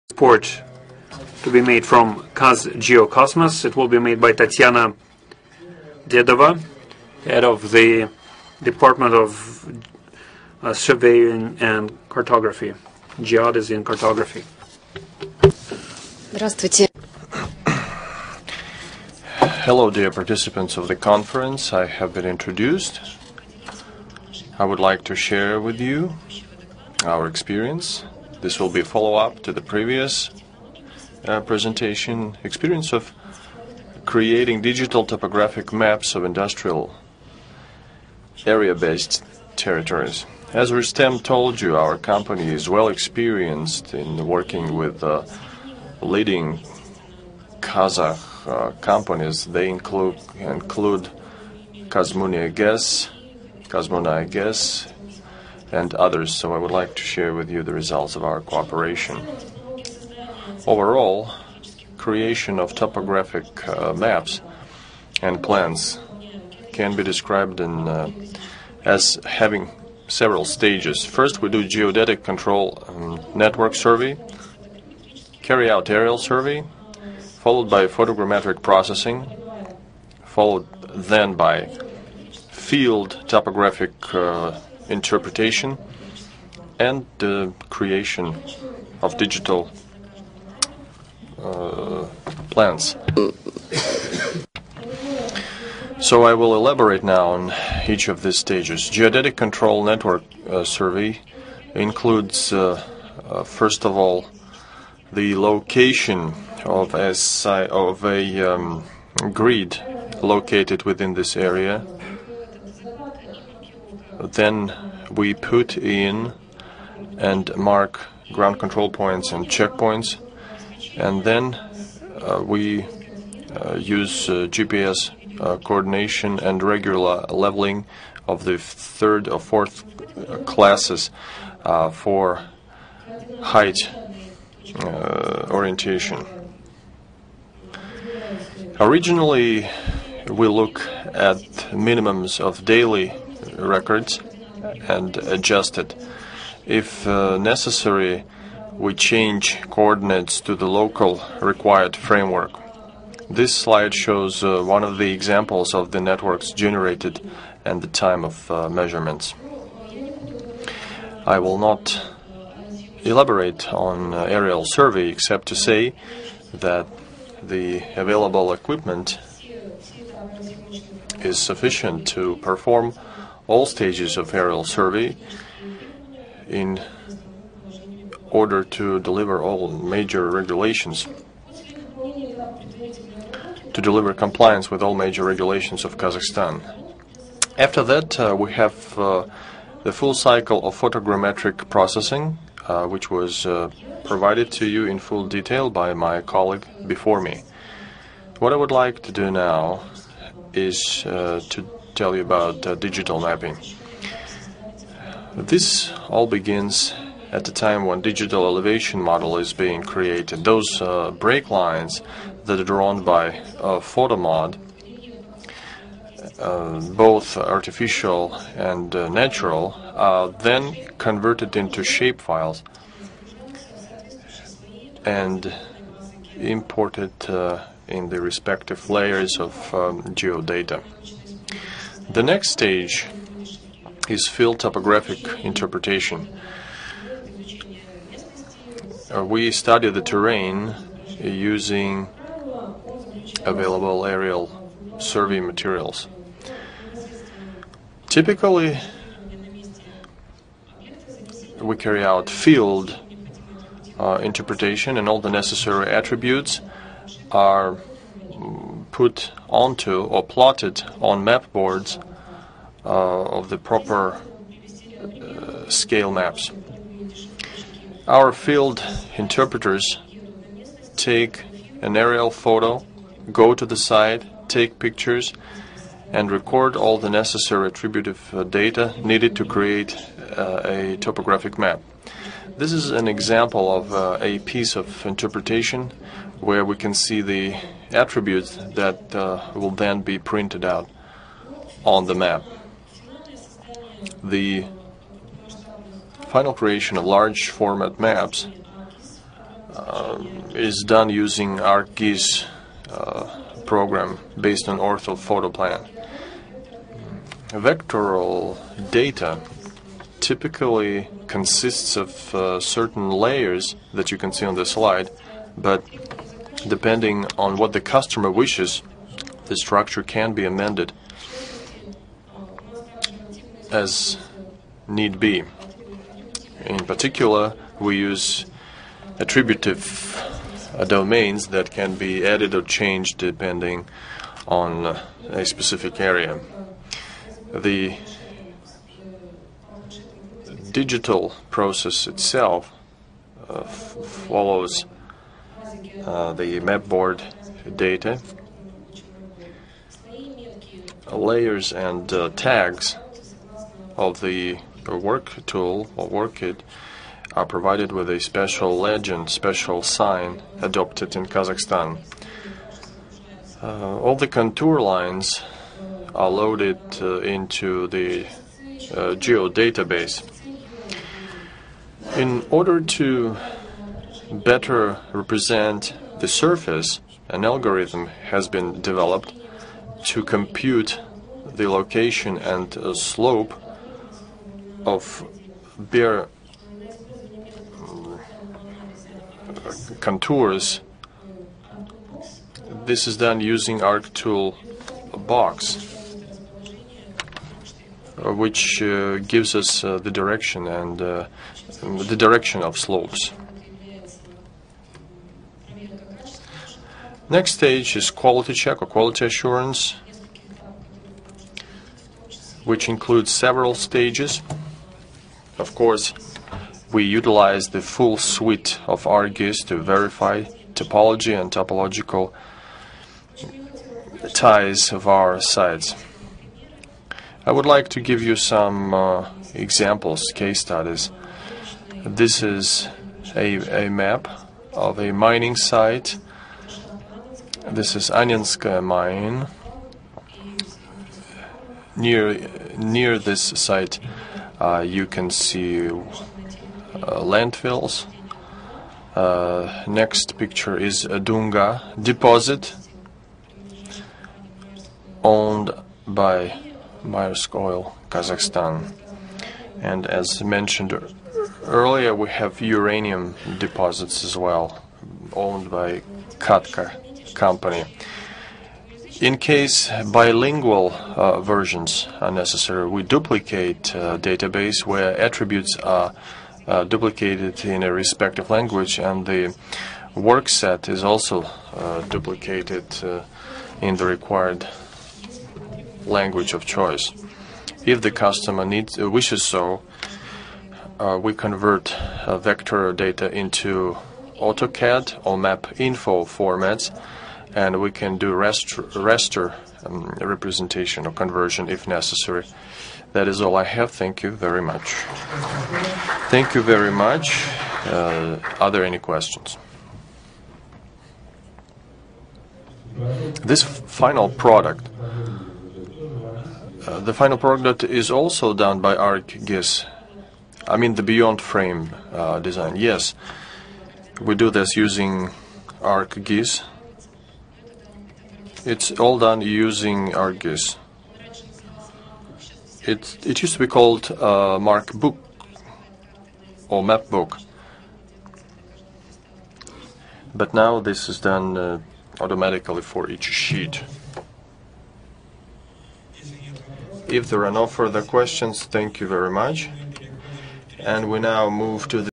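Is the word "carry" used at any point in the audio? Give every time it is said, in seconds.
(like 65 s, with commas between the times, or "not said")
75 s, 251 s.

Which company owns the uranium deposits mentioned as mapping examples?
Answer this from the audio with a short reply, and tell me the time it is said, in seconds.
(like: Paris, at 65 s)
KATCO, at 466 s.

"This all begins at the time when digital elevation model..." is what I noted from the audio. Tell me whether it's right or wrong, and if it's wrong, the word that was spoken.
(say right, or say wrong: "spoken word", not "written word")
right.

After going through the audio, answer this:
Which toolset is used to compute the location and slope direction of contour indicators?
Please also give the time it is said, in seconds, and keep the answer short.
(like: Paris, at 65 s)
ArcTool box, at 393 s.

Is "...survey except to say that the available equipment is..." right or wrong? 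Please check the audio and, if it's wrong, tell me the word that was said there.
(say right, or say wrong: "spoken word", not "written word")
right.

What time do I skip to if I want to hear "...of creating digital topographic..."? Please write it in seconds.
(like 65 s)
32 s.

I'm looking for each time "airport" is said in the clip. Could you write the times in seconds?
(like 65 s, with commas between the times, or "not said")
not said.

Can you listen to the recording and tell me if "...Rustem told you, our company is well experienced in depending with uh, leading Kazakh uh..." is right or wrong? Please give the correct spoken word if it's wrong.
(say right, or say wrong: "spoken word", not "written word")
wrong: "working", not "depending".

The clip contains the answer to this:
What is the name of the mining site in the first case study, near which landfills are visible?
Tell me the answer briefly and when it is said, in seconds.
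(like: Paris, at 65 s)
Anyanska mine, at 438 s.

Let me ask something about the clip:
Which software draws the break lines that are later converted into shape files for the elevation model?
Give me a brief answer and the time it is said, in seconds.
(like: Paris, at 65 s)
Photomod, at 213 s.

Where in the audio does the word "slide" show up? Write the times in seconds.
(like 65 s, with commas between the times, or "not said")
153 s, 314 s.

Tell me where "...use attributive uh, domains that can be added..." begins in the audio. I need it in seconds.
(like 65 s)
327 s.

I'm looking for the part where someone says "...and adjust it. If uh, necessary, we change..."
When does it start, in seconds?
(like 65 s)
144 s.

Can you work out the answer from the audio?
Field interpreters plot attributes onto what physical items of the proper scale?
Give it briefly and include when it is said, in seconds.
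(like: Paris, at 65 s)
map boards, at 261 s.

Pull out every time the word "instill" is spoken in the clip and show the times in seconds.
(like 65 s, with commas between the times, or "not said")
not said.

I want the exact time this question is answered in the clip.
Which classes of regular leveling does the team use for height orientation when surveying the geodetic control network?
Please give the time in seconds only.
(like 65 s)
128 s.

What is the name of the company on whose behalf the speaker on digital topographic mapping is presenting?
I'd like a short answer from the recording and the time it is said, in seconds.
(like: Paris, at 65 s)
Kaz Geocosmos, at 2 s.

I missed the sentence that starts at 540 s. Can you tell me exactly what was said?
But now this is done uh, automatically for each sheet.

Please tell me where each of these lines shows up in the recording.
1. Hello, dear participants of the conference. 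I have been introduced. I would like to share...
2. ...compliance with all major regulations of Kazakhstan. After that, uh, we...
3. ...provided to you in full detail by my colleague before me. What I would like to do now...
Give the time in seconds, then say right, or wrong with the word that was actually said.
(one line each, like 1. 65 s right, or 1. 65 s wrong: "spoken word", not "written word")
1. 19 s right
2. 184 s right
3. 194 s right.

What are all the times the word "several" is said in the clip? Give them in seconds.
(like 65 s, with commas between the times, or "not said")
70 s, 413 s.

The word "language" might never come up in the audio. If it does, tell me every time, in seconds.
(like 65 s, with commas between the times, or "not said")
478 s, 486 s.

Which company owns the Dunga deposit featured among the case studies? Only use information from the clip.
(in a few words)
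Maersk Oil.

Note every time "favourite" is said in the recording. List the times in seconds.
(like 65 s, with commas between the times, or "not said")
not said.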